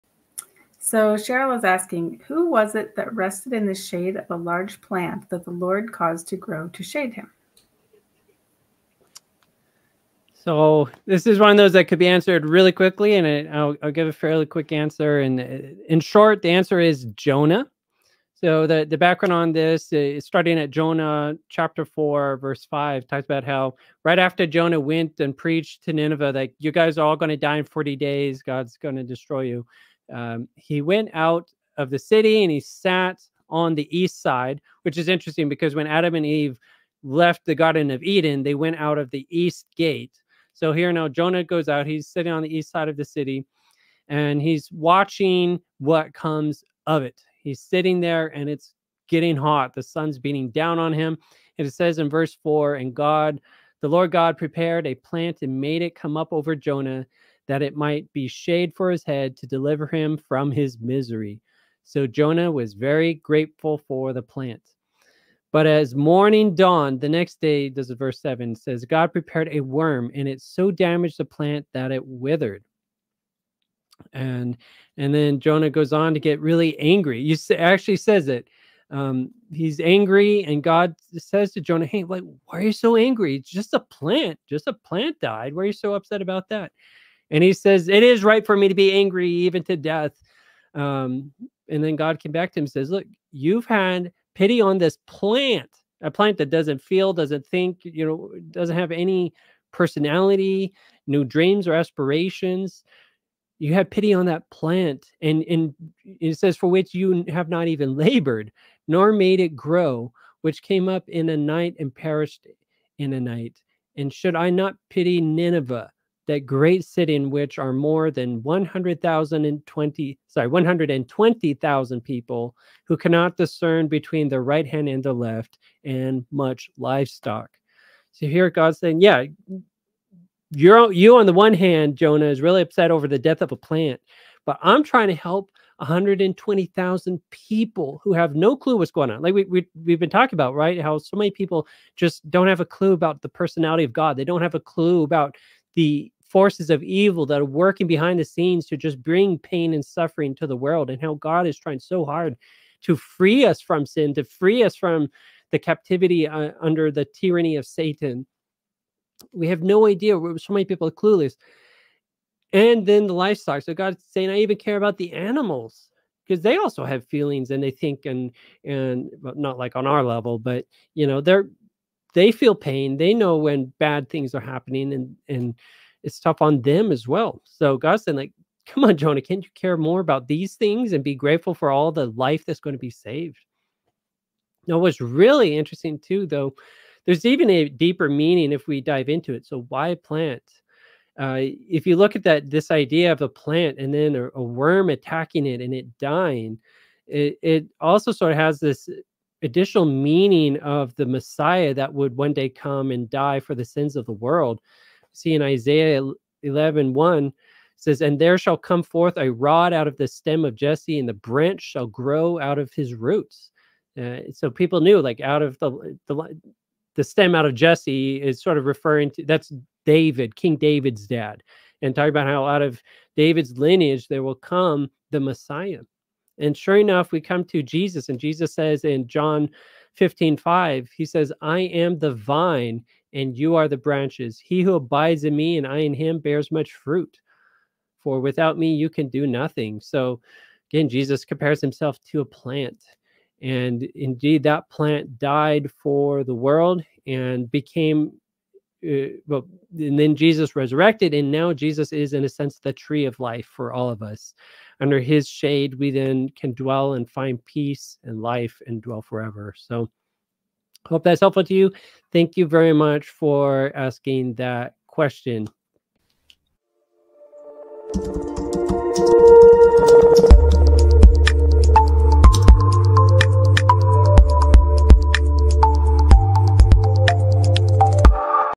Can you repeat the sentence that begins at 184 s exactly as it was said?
Now, what's really interesting too, though, there's even a deeper meaning if we dive into it.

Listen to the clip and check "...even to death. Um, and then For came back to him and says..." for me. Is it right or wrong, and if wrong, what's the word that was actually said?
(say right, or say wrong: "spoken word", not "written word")
wrong: "God", not "For".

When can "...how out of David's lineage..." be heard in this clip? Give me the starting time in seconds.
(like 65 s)
222 s.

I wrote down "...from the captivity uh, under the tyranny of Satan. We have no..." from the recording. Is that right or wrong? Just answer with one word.
right.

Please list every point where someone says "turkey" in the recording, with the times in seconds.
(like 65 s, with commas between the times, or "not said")
not said.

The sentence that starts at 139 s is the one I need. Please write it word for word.
Like we, we, we've been talking about, right?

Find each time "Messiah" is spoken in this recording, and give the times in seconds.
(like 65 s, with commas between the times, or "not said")
201 s, 225 s.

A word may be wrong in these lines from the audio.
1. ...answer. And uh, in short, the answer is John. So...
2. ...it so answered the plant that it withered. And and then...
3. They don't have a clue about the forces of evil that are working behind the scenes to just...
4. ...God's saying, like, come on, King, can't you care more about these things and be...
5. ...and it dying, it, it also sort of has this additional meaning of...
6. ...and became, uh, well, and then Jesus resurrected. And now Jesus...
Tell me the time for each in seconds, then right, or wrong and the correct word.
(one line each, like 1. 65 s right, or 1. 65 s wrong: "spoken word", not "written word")
1. 14 s wrong: "Jonah", not "John"
2. 70 s wrong: "damaged", not "answered"
3. 144 s right
4. 177 s wrong: "Jonah", not "King"
5. 195 s right
6. 247 s right.